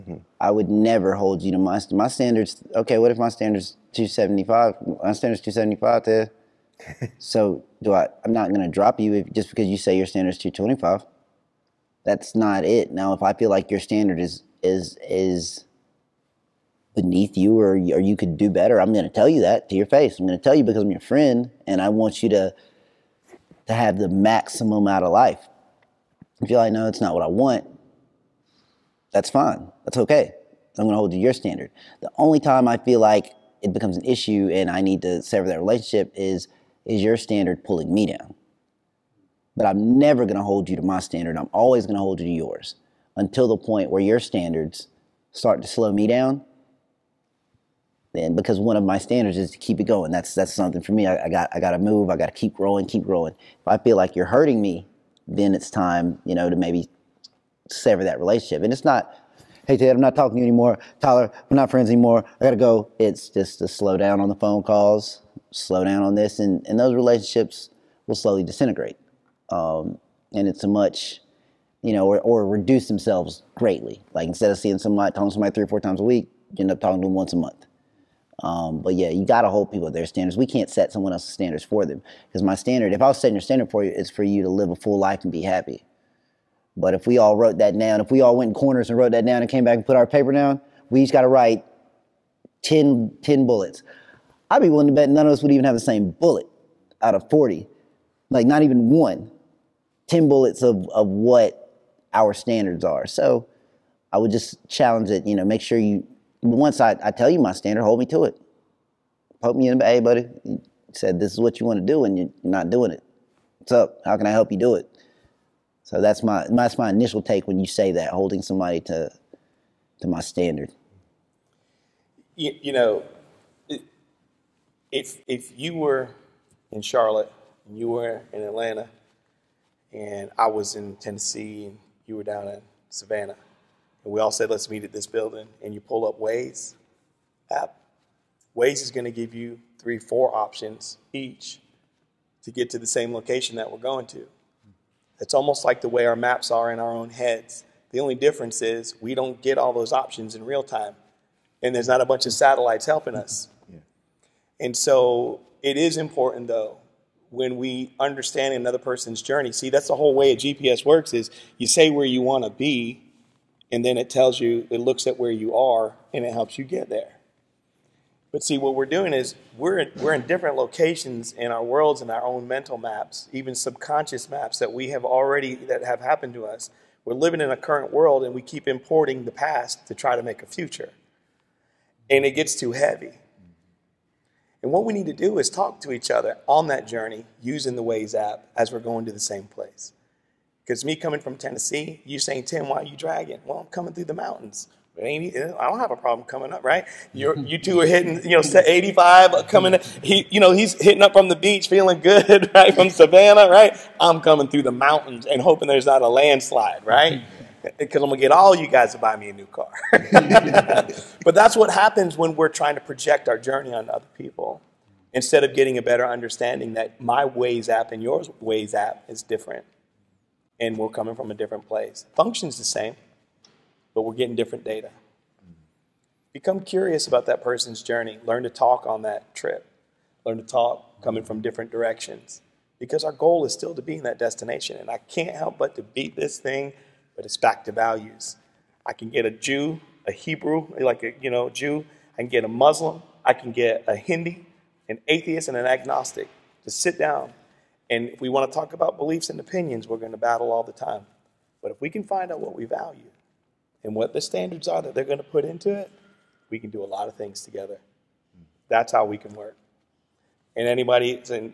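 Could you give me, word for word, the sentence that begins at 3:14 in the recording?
I don't have a problem coming up, right?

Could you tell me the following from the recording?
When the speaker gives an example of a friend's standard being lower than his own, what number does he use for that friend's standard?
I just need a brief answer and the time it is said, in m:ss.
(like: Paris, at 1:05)
225, at 0:10.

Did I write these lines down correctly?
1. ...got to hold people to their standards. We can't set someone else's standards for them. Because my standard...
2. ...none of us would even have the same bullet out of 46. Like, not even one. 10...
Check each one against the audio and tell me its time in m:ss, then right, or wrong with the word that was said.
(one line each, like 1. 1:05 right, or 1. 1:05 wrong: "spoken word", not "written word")
1. 1:19 right
2. 1:35 wrong: "40", not "46".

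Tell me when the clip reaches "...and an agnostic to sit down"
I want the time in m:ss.
4:05.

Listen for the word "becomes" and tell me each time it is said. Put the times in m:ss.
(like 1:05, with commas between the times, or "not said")
0:33, 3:46.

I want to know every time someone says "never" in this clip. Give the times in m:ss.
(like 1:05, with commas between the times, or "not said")
0:00, 0:39.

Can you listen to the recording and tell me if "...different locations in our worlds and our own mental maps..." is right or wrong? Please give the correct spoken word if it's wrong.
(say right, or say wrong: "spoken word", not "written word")
right.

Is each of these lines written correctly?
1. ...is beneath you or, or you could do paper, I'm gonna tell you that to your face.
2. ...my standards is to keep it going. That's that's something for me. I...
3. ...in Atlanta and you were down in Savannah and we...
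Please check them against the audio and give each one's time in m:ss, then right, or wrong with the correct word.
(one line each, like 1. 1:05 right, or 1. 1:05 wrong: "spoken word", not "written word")
1. 0:15 wrong: "better", not "paper"
2. 0:48 right
3. 2:10 wrong: "Tennessee", not "Atlanta".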